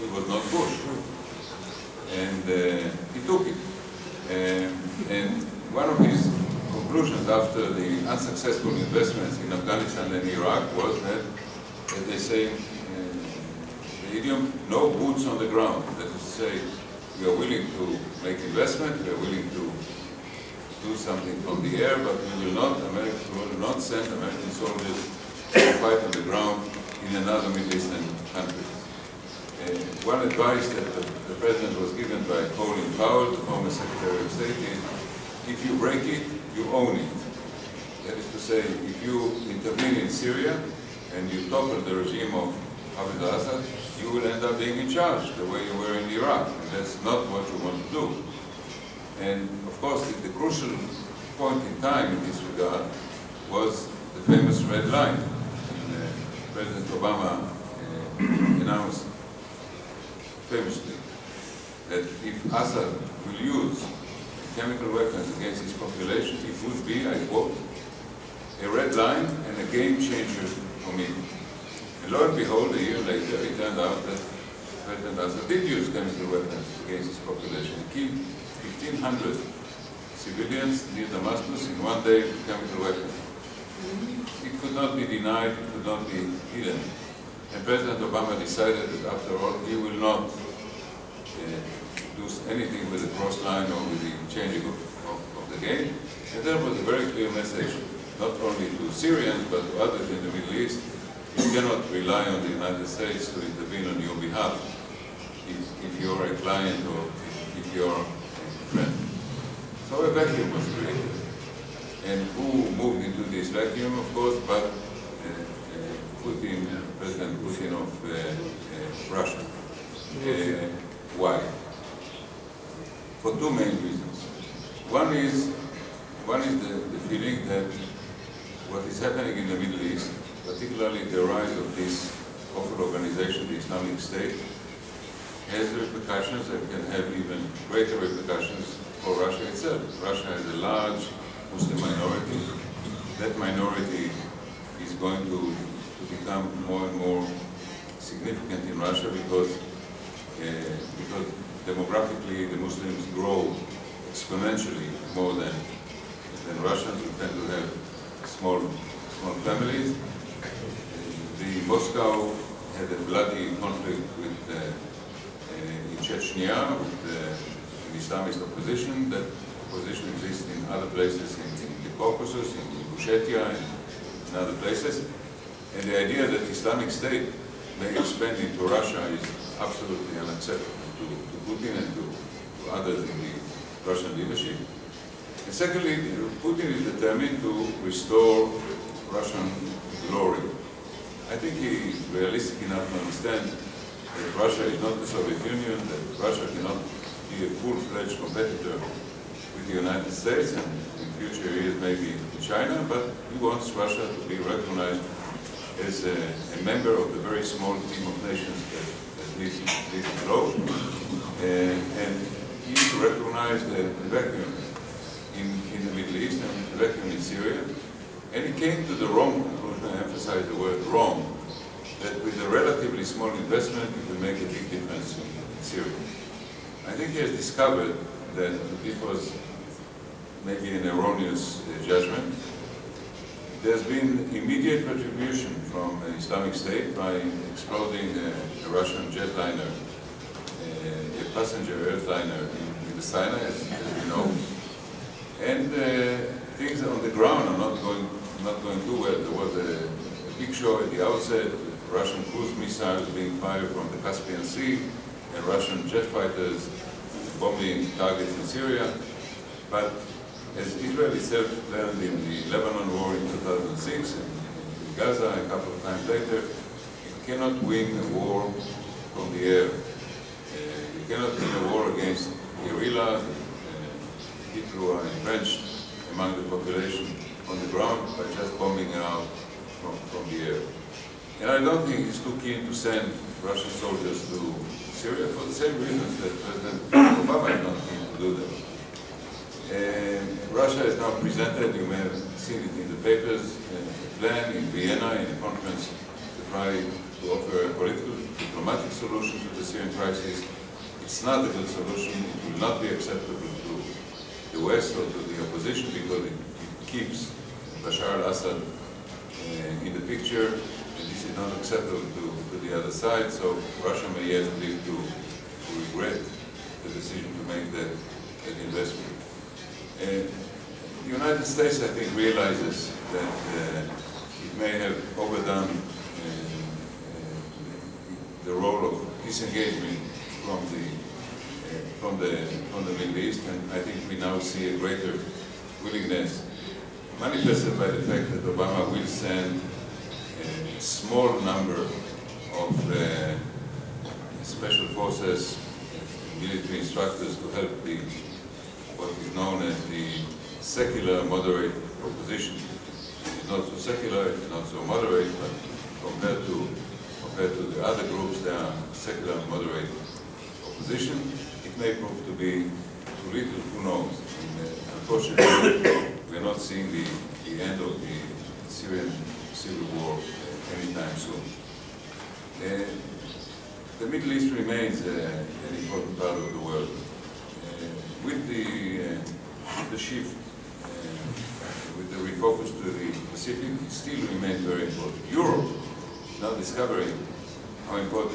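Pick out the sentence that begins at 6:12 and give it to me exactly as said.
Uh, the Middle East remains uh, an important part of the world.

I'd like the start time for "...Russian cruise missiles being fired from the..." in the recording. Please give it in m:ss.
4:11.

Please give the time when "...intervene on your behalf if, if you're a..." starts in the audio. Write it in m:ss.
1:43.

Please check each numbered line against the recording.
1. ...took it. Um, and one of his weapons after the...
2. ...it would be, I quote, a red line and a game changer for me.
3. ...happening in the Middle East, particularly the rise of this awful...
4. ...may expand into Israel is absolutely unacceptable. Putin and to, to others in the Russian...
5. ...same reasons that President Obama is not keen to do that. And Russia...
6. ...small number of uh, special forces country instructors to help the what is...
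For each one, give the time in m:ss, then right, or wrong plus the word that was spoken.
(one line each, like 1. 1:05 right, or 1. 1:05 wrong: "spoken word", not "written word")
1. 0:03 wrong: "conclusions", not "weapons"
2. 1:06 right
3. 2:08 right
4. 2:57 wrong: "Russia", not "Israel"
5. 4:45 right
6. 5:40 wrong: "military", not "country".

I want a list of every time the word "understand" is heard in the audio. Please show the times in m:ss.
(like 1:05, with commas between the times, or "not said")
3:12.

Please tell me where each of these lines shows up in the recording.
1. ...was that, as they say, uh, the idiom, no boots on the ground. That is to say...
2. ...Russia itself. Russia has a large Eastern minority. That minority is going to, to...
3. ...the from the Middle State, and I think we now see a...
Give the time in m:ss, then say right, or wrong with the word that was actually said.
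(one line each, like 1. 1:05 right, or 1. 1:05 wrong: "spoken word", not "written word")
1. 0:10 right
2. 2:19 wrong: "Muslim", not "Eastern"
3. 5:32 wrong: "East", not "State".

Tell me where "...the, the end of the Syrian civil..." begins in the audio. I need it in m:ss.
6:06.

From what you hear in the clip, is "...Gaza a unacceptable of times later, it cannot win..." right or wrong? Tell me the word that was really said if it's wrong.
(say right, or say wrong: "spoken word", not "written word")
wrong: "couple", not "unacceptable".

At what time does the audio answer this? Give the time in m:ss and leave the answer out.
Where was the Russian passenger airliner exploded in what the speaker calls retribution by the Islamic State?
4:03.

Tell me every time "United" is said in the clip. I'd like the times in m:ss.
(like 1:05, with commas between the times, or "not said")
1:42, 3:19, 5:21.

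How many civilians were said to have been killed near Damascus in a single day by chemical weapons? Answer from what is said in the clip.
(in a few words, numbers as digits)
1,500.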